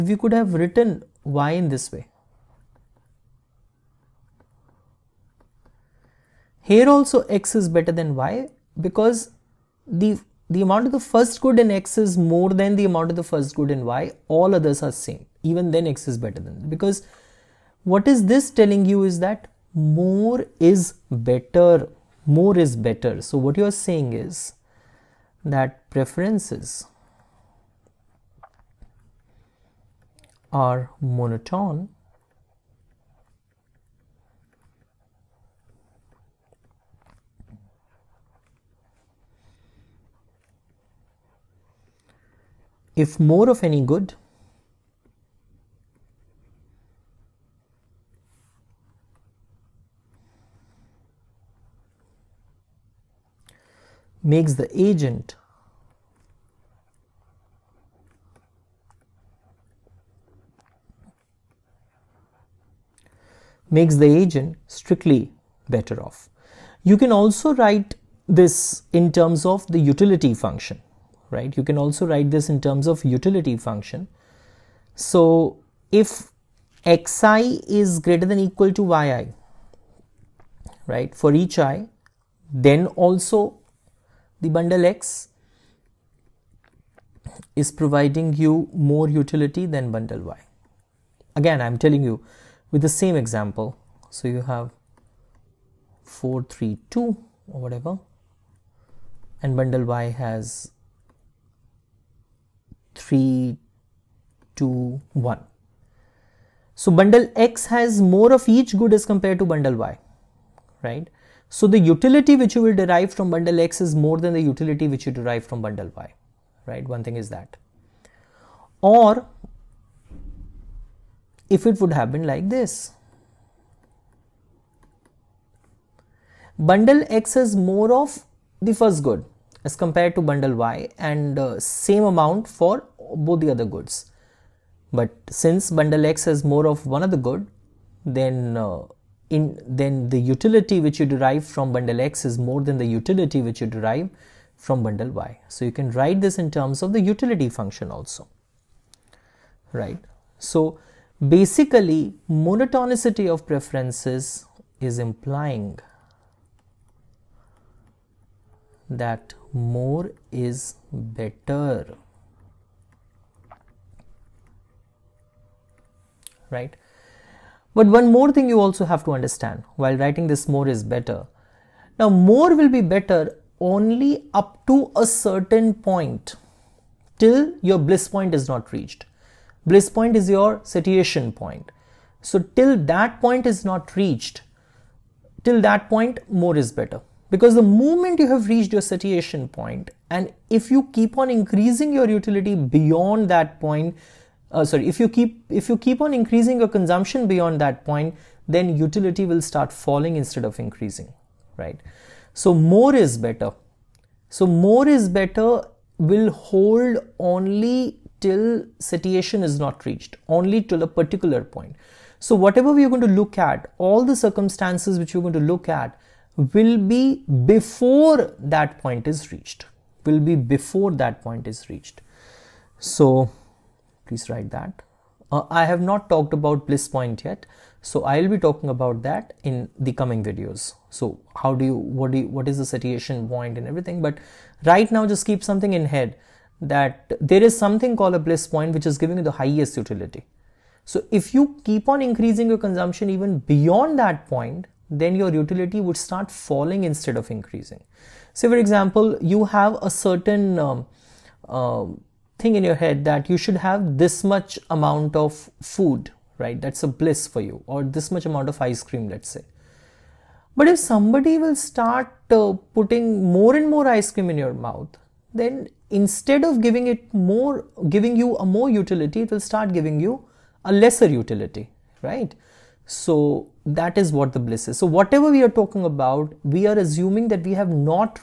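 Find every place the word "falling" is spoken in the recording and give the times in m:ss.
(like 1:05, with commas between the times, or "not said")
3:19, 4:06.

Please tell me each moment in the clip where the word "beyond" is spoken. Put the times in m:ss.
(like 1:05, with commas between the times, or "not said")
3:12, 3:17, 4:03.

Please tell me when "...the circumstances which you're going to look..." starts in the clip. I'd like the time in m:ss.
3:34.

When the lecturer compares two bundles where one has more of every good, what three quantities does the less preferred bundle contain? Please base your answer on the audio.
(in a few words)
3, 2, 1.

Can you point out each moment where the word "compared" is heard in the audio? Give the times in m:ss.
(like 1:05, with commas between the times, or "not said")
1:49, 2:09.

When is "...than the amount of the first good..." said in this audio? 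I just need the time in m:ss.
0:12.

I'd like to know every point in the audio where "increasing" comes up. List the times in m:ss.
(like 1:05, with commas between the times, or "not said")
3:11, 3:16, 3:20, 4:02, 4:07.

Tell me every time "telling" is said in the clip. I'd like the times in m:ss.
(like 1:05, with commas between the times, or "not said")
0:18, 1:31.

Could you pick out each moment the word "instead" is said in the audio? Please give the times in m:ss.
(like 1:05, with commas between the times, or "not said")
3:20, 4:06, 4:26.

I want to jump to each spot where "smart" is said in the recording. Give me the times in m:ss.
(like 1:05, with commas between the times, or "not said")
not said.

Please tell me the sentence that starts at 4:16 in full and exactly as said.
That's a bliss for you, or this much amount of ice cream, let's say.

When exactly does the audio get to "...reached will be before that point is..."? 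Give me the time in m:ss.
3:39.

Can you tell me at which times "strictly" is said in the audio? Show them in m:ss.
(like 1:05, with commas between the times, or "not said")
1:04.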